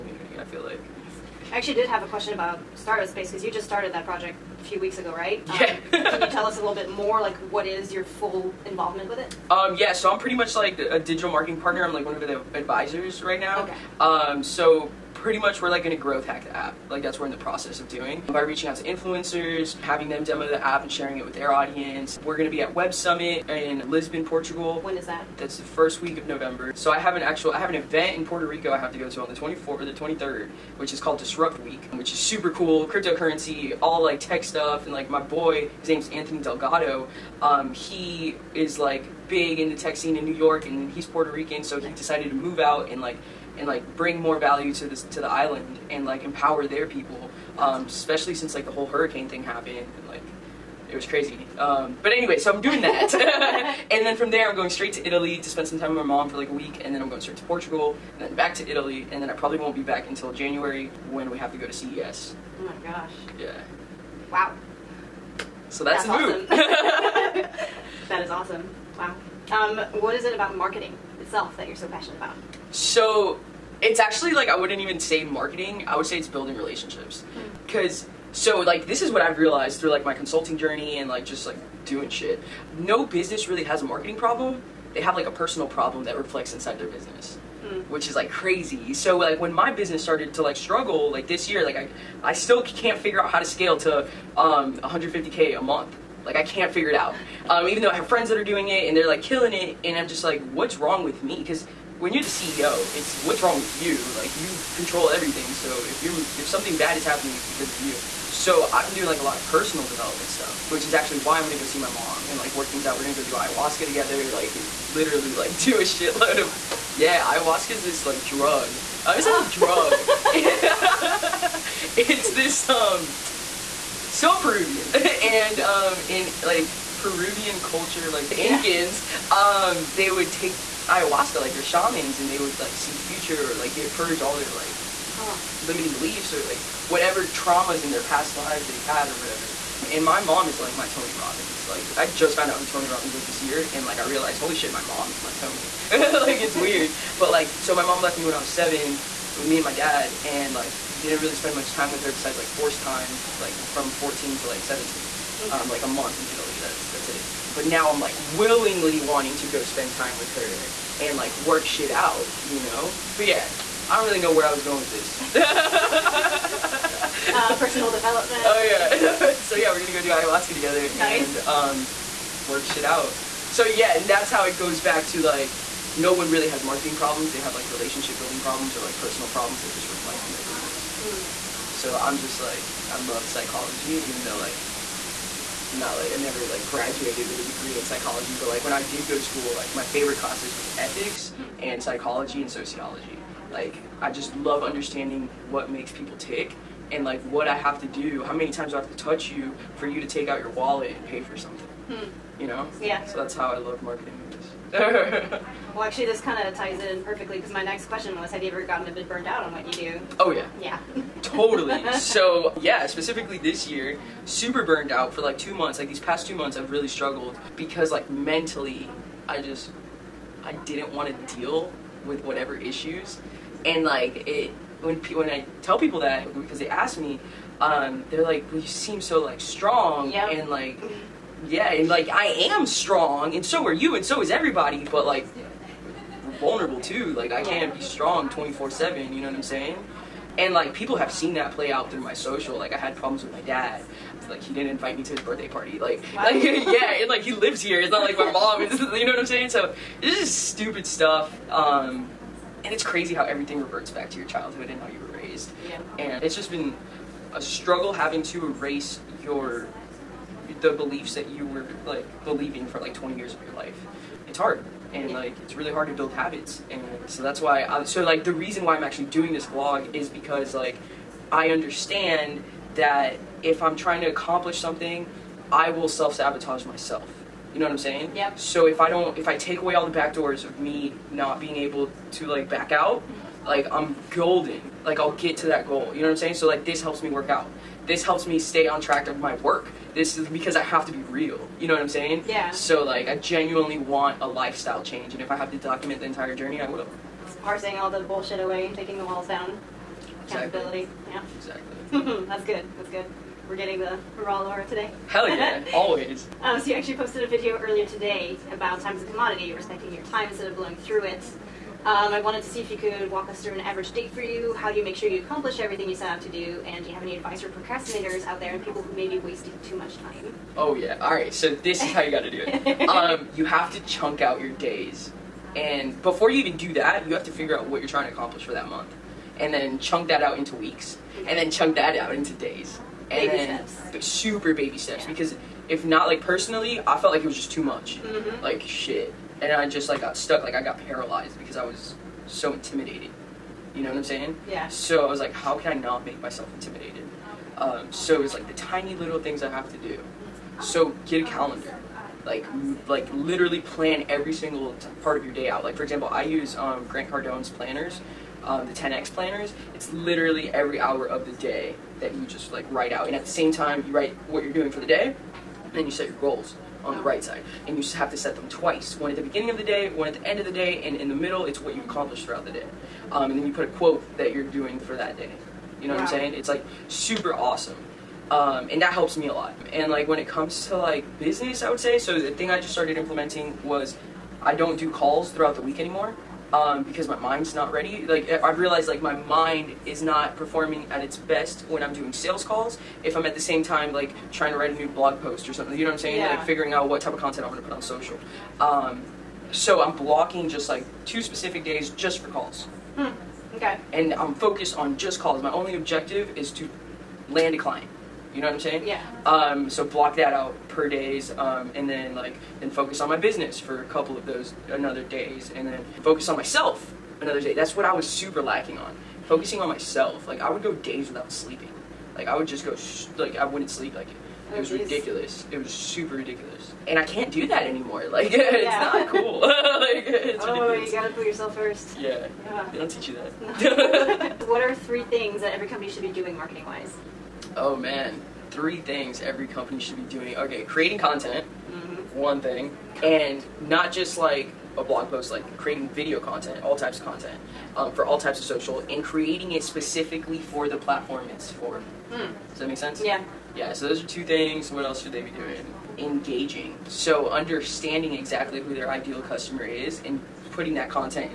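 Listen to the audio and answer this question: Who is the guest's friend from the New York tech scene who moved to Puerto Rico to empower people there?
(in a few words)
Anthony Delgado.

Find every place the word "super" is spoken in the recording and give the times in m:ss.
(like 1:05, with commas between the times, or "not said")
0:32, 3:34, 5:34, 6:16, 6:58, 7:05.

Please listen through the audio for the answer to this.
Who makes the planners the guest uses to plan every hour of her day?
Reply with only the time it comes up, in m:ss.
5:56.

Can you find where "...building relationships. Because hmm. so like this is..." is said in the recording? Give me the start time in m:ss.
1:16.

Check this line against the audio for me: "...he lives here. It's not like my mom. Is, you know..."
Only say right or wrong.
right.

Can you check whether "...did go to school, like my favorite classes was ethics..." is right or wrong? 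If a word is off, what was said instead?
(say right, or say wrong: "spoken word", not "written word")
right.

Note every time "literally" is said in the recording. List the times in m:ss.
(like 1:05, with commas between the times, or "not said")
1:54, 5:53, 5:59.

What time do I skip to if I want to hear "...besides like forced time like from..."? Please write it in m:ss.
2:32.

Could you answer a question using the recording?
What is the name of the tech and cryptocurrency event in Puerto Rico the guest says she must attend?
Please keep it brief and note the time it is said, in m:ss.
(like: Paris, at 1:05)
Disrupt Week, at 0:31.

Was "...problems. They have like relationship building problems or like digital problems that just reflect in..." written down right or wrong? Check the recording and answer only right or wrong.
wrong.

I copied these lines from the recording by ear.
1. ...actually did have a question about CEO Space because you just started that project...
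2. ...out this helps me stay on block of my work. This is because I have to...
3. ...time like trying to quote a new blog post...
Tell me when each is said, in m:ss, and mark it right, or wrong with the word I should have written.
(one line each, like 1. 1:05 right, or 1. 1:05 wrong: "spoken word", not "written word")
1. 0:01 wrong: "Startup", not "CEO"
2. 4:47 wrong: "track", not "block"
3. 6:33 wrong: "write", not "quote".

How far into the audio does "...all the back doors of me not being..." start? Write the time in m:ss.
4:39.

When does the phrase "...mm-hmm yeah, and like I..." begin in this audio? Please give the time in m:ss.
3:50.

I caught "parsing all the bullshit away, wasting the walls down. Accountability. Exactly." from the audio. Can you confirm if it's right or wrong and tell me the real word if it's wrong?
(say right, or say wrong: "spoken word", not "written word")
wrong: "taking", not "wasting".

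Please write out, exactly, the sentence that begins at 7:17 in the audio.
oh man, three things every company should be doing.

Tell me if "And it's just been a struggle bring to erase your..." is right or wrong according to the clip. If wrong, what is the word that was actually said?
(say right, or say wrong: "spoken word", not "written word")
wrong: "having", not "bring".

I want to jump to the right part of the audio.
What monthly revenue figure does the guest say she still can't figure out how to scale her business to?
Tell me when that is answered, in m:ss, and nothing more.
1:34.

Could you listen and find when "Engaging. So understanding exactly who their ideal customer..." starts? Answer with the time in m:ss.
7:35.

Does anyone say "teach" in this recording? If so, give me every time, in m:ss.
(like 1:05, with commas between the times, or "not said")
7:12.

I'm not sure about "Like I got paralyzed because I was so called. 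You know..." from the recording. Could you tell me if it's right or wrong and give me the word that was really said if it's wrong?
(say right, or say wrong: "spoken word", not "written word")
wrong: "intimidated", not "called".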